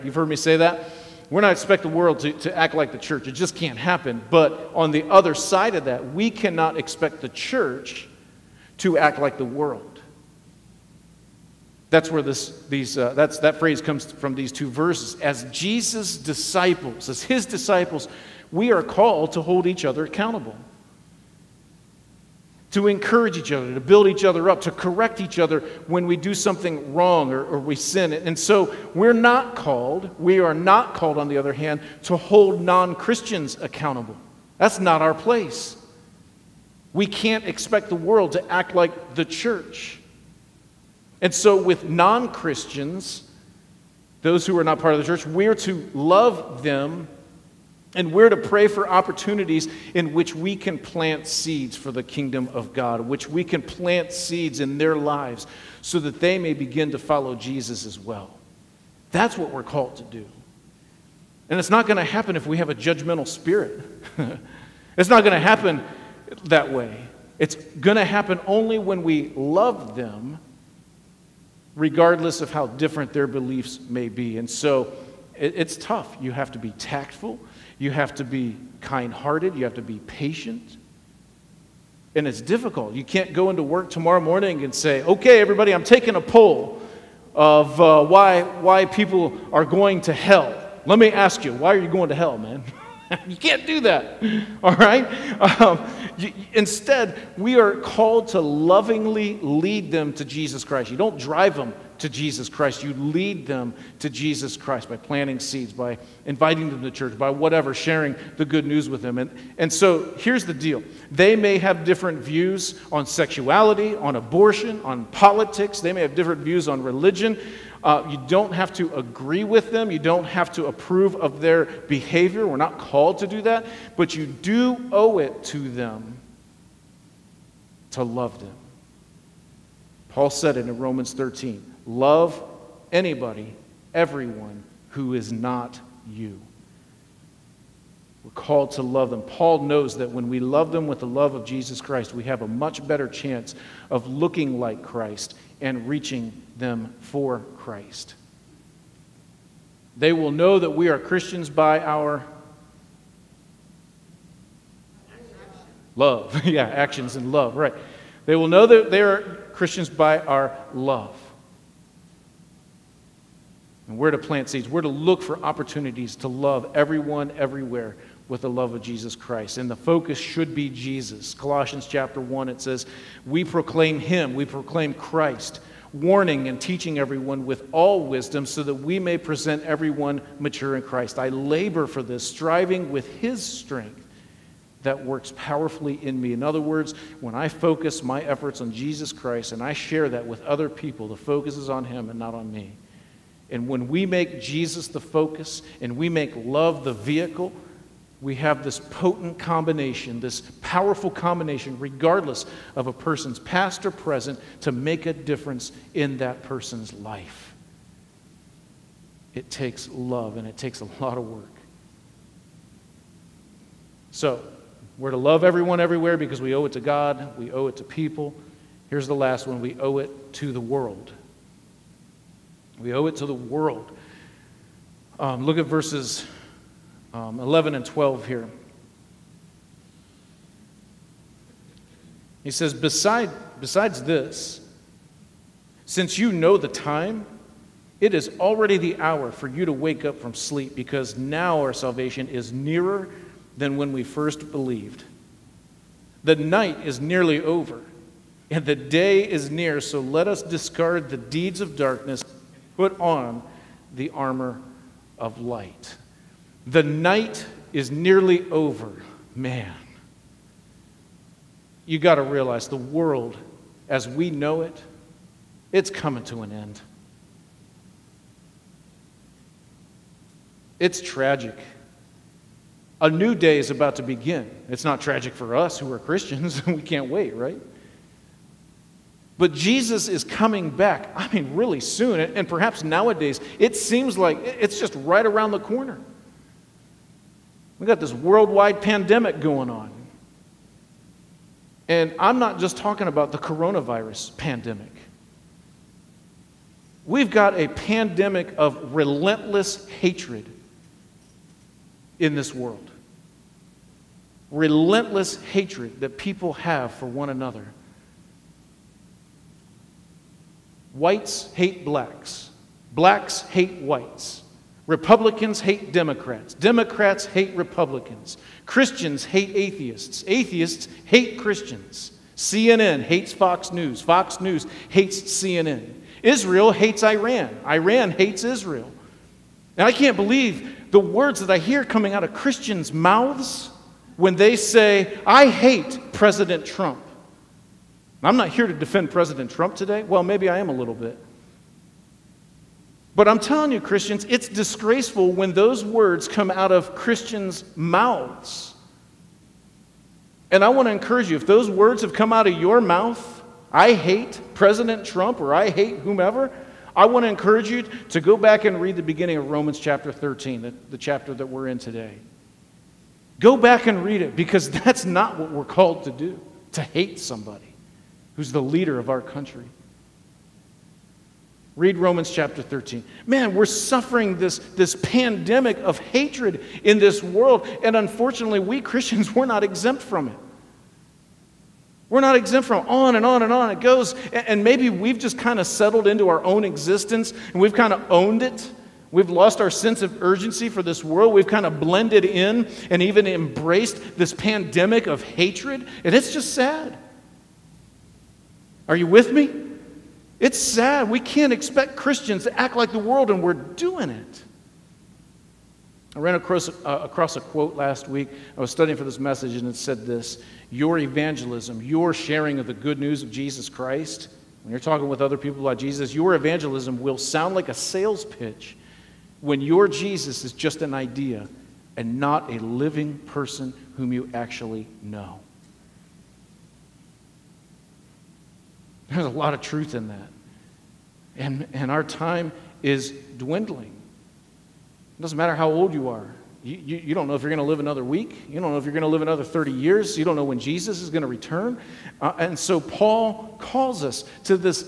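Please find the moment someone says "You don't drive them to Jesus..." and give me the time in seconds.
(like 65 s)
100 s.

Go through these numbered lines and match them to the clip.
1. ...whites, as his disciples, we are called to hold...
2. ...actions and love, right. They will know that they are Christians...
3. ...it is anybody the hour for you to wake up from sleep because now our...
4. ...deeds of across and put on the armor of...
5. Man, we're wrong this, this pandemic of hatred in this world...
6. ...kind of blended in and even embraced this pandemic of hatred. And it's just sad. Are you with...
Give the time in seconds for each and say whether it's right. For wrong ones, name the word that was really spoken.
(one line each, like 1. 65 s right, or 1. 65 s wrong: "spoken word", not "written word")
1. 16 s wrong: "disciples", not "whites"
2. 156 s right
3. 238 s wrong: "already", not "anybody"
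4. 251 s wrong: "darkness", not "across"
5. 373 s wrong: "suffering", not "wrong"
6. 391 s right.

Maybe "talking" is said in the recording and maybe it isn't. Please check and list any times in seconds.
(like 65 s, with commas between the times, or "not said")
292 s, 414 s.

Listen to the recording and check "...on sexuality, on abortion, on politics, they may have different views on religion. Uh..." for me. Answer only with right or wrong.
right.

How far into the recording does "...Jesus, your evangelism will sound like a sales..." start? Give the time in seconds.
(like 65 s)
415 s.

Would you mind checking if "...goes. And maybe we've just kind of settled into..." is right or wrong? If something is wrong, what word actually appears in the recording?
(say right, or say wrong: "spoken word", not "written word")
right.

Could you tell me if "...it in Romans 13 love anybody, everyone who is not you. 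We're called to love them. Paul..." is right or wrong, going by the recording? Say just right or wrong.
right.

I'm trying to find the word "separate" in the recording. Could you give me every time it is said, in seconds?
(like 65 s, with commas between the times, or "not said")
not said.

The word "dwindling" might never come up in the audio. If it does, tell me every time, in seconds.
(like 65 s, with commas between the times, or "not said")
433 s.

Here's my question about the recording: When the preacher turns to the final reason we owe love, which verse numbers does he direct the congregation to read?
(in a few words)
11 and 12.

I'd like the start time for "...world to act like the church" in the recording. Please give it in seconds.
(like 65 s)
37 s.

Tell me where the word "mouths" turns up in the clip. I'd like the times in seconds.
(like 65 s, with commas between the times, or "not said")
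332 s, 347 s, 352 s.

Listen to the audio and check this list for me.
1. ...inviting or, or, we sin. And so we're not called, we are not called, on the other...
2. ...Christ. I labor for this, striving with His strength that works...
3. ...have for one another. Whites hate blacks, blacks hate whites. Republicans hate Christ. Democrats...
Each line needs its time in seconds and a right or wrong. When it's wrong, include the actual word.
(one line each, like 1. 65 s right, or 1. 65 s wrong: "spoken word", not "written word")
1. 26 s wrong: "wrong", not "inviting"
2. 180 s right
3. 306 s wrong: "Democrats", not "Christ".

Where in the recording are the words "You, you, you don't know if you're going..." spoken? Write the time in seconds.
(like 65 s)
436 s.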